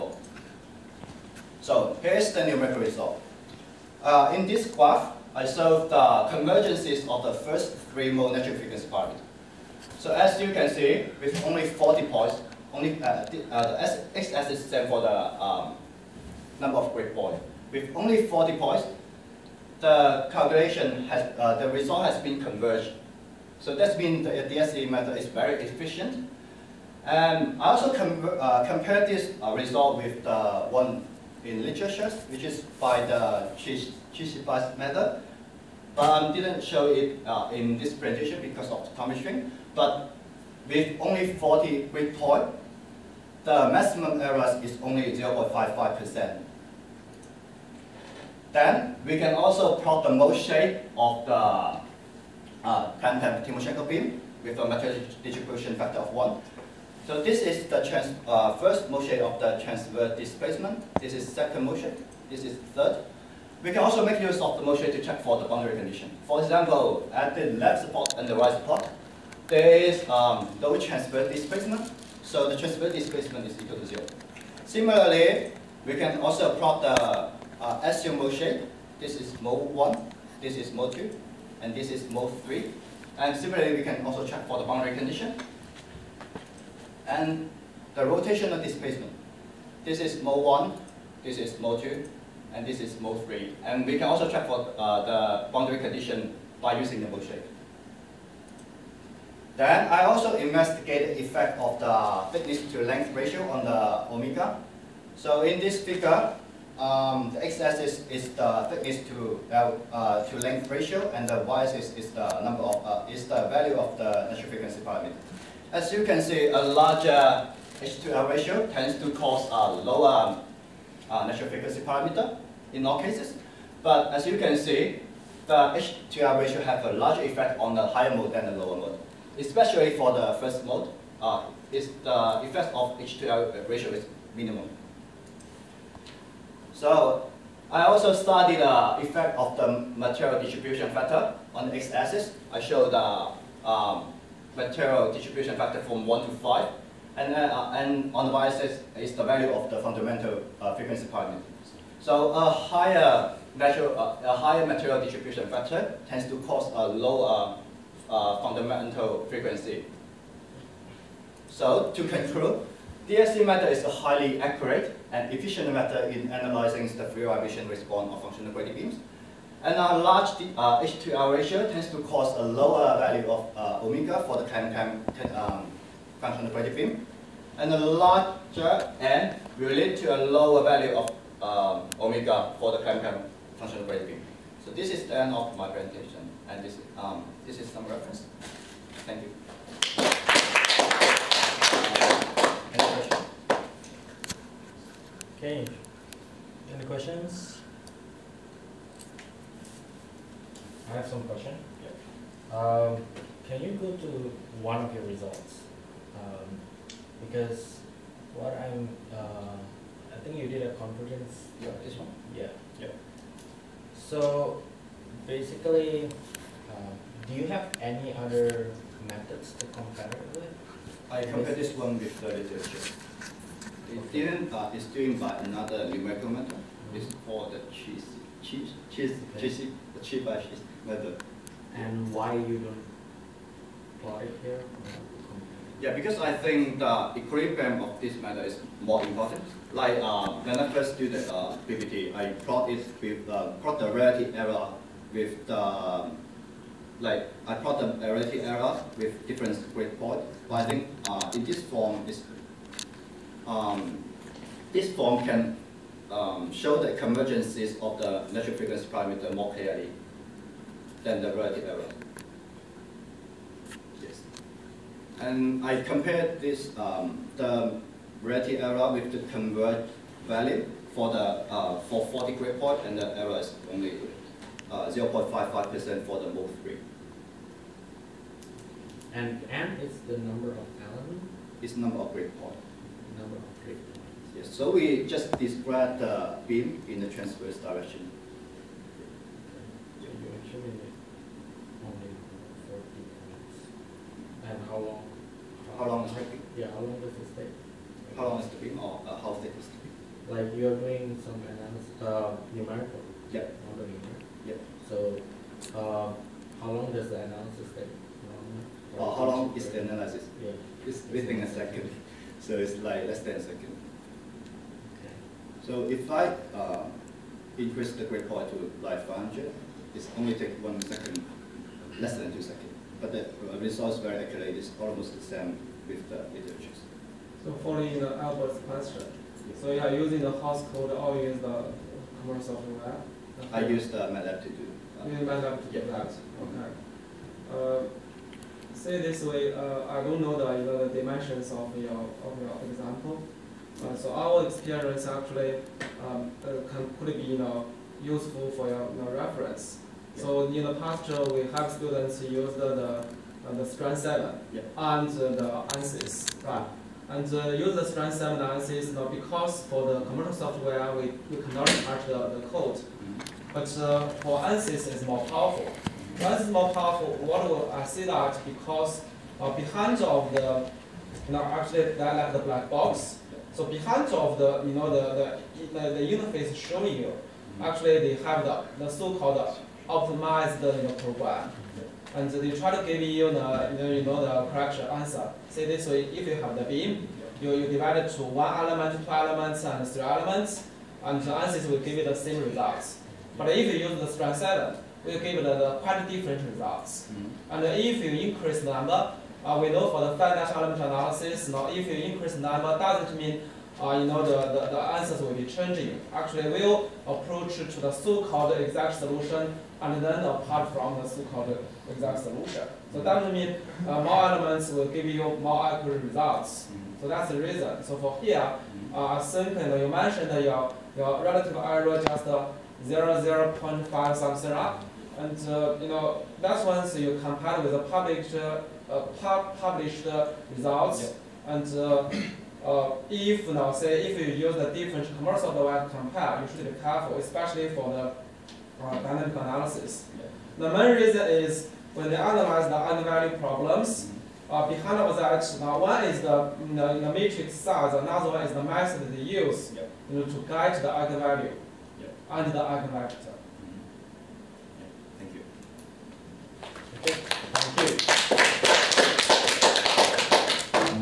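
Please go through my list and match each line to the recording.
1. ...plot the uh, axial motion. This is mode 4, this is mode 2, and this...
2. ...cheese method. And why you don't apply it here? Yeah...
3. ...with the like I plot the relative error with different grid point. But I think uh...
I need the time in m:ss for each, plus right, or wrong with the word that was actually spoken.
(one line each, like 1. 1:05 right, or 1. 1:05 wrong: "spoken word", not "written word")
1. 1:16 wrong: "1", not "4"
2. 3:50 right
3. 4:05 right.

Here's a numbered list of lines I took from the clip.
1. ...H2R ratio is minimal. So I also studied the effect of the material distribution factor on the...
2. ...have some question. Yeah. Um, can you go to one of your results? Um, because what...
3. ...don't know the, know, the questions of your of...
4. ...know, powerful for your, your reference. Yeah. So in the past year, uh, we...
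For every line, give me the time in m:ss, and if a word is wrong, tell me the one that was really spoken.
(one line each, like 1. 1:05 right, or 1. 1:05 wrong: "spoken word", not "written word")
1. 2:12 right
2. 3:20 right
3. 5:40 wrong: "dimensions", not "questions"
4. 5:47 wrong: "useful", not "powerful".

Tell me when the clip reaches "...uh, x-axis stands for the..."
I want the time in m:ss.
0:13.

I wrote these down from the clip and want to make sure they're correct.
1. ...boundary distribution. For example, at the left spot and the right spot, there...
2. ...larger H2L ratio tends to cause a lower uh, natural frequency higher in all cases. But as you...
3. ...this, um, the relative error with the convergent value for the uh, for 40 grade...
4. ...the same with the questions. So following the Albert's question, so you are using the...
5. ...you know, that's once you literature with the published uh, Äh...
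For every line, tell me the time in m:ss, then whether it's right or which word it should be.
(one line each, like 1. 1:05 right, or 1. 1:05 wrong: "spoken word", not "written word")
1. 1:05 wrong: "condition", not "distribution"
2. 1:56 wrong: "parameter", not "higher"
3. 4:26 right
4. 5:25 wrong: "iterations", not "questions"
5. 7:05 wrong: "compare", not "literature".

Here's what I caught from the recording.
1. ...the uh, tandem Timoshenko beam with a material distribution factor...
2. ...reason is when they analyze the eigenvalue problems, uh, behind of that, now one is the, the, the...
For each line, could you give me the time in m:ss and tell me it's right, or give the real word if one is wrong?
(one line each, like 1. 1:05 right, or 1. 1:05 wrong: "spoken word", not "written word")
1. 0:51 right
2. 7:20 right.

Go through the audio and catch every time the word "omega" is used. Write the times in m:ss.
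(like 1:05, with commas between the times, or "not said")
1:44, 2:53, 3:01.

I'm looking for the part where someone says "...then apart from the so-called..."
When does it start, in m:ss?
6:50.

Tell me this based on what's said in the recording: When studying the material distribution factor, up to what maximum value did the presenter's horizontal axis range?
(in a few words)
5.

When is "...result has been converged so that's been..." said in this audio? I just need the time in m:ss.
0:21.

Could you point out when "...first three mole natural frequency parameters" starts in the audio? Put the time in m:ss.
0:07.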